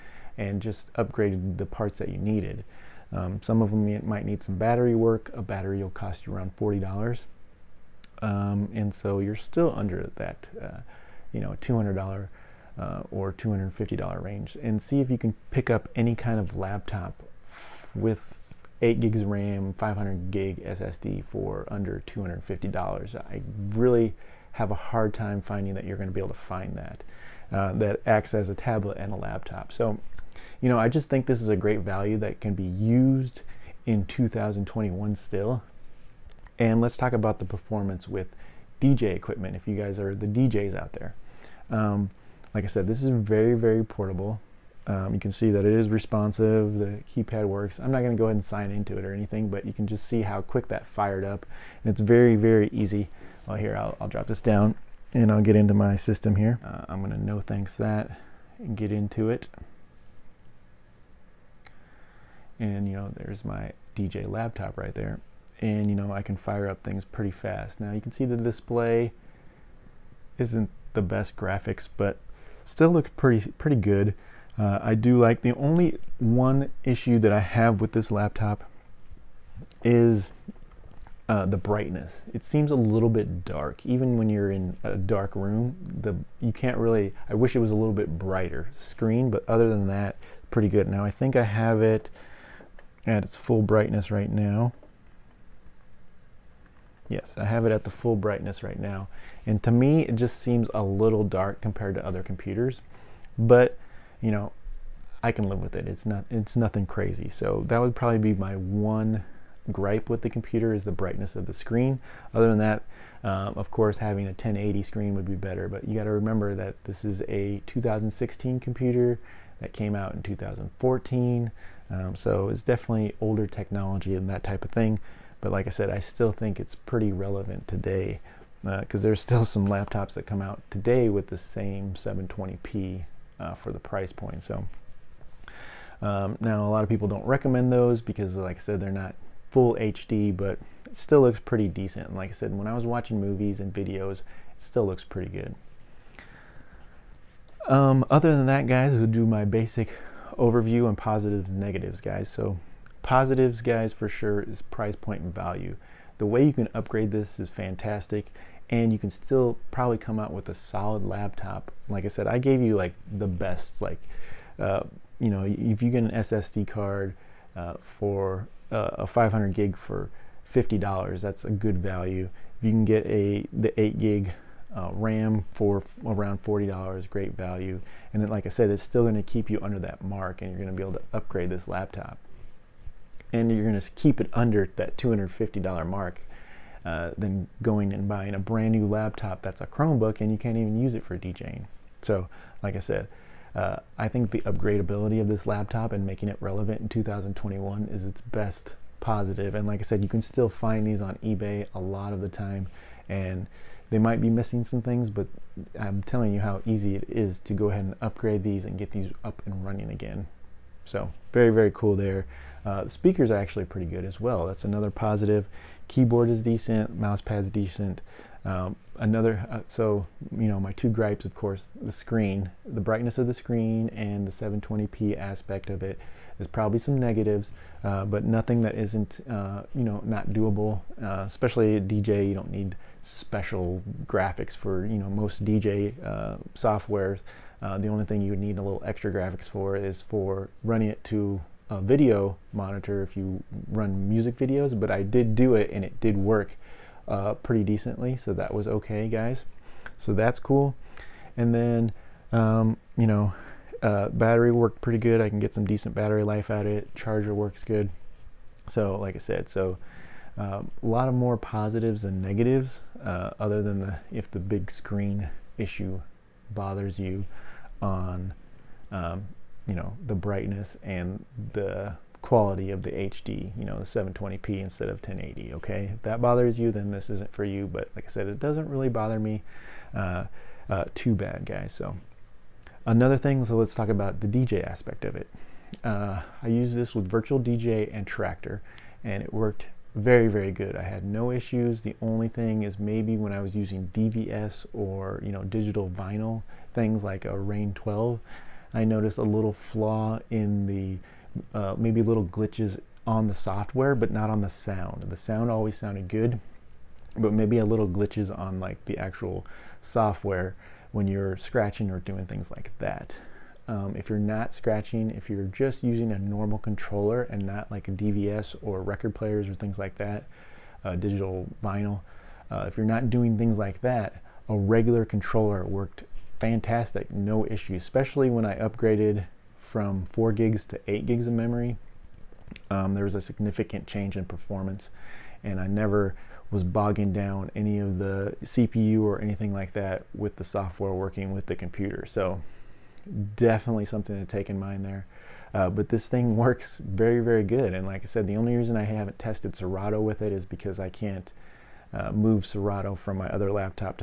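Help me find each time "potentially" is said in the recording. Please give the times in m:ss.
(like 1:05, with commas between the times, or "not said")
not said.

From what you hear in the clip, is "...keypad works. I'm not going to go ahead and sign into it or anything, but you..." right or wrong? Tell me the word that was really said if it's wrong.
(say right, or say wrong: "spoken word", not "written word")
right.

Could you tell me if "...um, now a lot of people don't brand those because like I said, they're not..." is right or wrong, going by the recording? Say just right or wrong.
wrong.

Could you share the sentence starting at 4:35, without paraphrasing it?
If that bothers you, then this isn't for you, but like I said, it doesn't really bother me.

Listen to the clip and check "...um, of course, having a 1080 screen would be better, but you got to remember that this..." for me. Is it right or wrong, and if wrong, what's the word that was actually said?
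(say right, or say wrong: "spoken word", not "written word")
right.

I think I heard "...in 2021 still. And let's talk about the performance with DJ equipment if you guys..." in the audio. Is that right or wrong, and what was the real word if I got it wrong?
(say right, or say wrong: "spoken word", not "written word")
right.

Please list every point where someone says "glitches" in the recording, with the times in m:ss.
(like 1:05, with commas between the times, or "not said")
5:02, 5:07.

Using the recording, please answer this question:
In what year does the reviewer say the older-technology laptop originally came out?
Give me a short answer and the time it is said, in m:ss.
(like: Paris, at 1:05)
2014, at 2:00.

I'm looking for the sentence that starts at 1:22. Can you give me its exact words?
It seems a little bit dark, even when you're in a dark room.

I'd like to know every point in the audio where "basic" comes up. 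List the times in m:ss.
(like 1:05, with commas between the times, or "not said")
2:29.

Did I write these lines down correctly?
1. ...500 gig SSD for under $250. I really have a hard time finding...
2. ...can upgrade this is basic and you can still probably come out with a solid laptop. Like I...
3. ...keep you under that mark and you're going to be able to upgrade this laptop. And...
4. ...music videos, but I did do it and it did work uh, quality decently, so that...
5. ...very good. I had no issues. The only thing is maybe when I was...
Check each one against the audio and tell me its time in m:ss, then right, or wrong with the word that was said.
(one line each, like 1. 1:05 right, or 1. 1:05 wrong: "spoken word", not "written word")
1. 0:19 right
2. 2:36 wrong: "fantastic", not "basic"
3. 2:59 right
4. 4:04 wrong: "pretty", not "quality"
5. 4:50 right.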